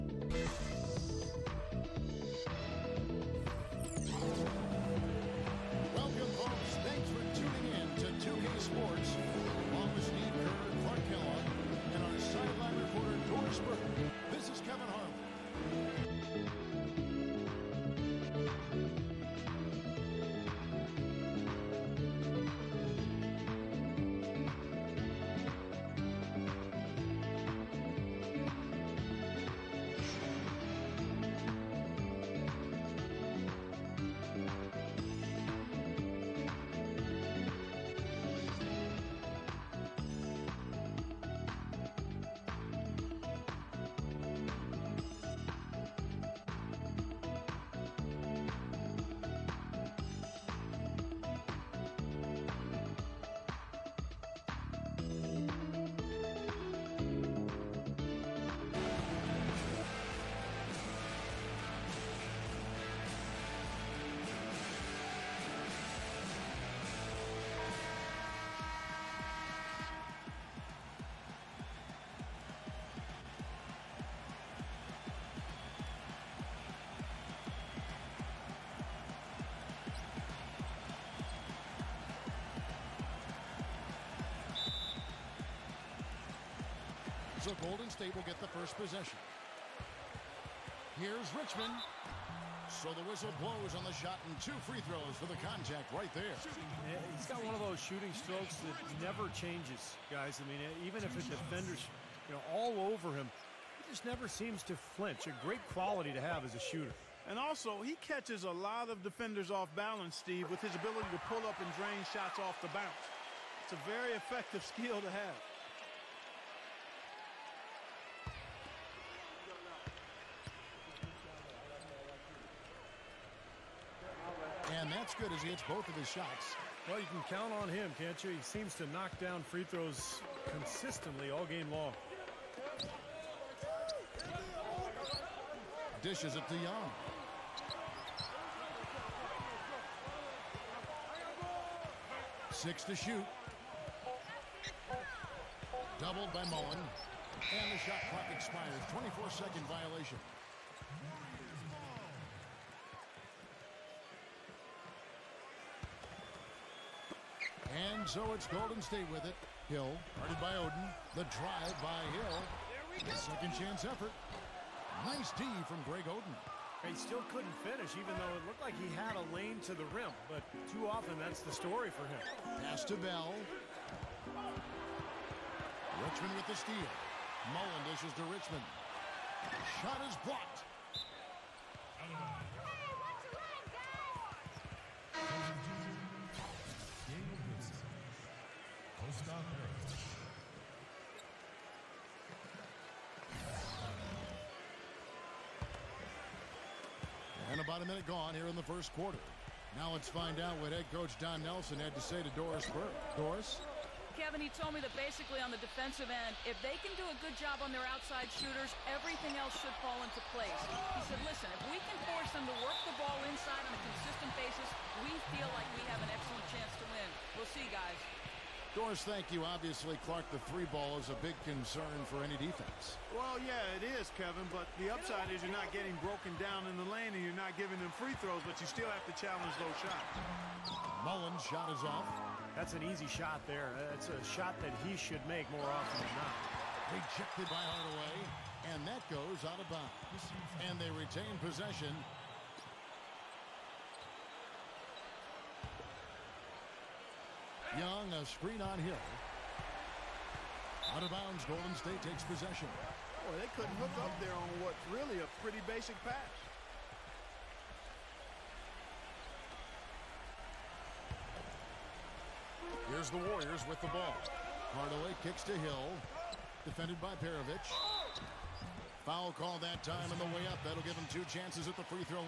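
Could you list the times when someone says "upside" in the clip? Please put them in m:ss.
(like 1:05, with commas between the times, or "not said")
3:44.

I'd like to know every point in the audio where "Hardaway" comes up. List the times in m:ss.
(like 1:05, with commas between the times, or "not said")
3:57, 4:24.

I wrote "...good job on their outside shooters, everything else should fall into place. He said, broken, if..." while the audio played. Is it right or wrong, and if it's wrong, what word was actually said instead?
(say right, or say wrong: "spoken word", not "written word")
wrong: "listen", not "broken".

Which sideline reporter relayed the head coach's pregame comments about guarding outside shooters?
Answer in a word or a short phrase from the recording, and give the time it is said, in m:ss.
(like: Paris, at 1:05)
Doris Burke, at 3:22.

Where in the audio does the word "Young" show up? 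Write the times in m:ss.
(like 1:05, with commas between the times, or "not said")
2:16, 4:07.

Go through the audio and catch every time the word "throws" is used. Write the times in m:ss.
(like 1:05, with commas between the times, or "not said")
1:34, 2:09, 3:48.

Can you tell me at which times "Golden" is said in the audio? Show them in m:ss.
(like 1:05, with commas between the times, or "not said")
1:27, 2:38, 4:11.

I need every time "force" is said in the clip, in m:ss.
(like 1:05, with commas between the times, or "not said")
3:32.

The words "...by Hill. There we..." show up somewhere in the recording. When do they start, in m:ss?
2:41.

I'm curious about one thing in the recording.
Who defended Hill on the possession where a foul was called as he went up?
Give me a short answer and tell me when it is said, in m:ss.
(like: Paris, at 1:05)
Perovich, at 4:27.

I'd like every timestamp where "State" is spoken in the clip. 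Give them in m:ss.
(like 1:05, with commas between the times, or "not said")
1:27, 2:38, 4:11.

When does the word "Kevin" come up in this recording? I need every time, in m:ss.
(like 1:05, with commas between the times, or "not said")
3:24, 3:44.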